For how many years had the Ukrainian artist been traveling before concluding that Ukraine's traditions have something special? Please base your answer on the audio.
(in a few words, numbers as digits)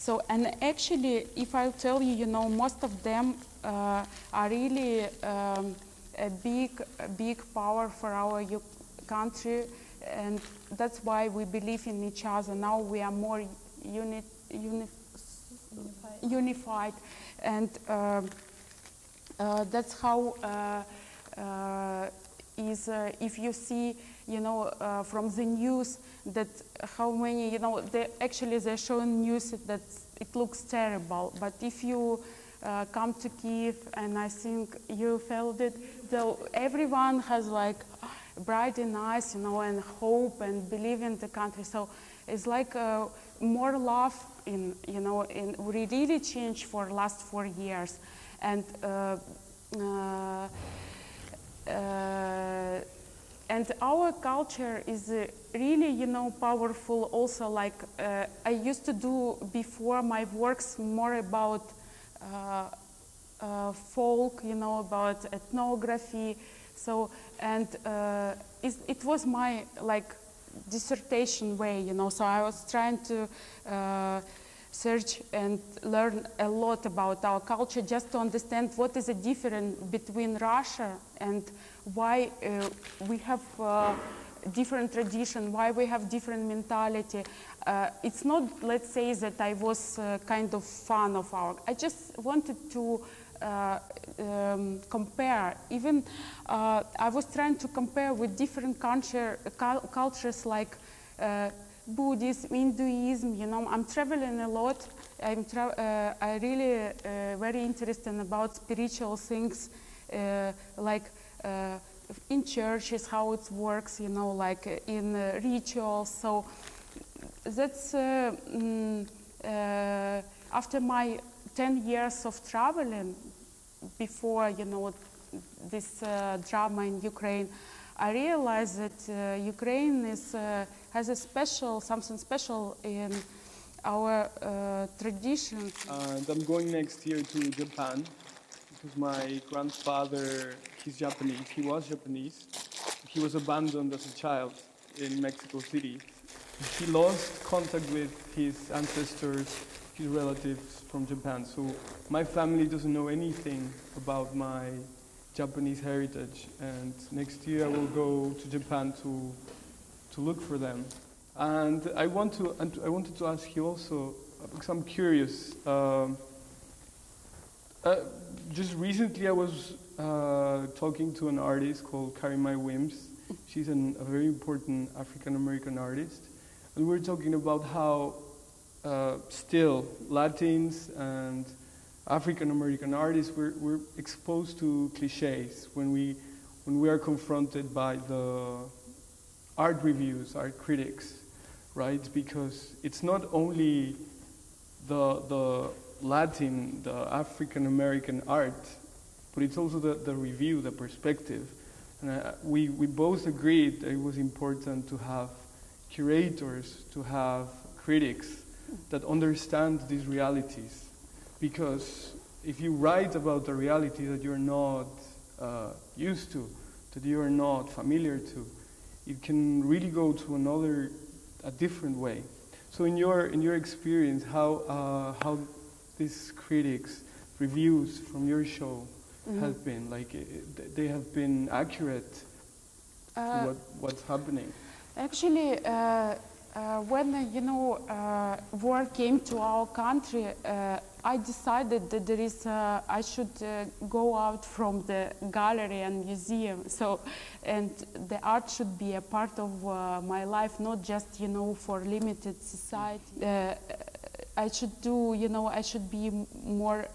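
10 years.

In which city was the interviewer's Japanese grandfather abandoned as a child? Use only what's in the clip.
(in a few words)
Mexico City.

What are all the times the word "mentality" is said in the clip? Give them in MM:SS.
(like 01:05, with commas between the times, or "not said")
01:26.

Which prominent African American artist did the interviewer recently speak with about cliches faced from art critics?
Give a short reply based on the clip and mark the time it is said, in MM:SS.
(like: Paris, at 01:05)
Carrie Mae Weems, at 02:52.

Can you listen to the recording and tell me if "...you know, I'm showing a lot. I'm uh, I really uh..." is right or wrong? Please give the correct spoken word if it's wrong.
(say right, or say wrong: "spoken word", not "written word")
wrong: "traveling", not "showing".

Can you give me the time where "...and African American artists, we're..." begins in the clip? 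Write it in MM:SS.
03:00.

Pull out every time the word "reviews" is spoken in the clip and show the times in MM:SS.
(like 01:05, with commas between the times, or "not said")
03:09, 03:20, 03:47.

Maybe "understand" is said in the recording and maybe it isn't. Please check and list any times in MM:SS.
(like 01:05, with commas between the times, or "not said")
01:18, 03:29.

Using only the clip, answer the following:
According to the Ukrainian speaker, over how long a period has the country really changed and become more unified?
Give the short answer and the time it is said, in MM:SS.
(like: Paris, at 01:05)
4 years, at 00:47.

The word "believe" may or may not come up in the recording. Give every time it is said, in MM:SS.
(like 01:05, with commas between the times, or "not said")
00:11, 00:40.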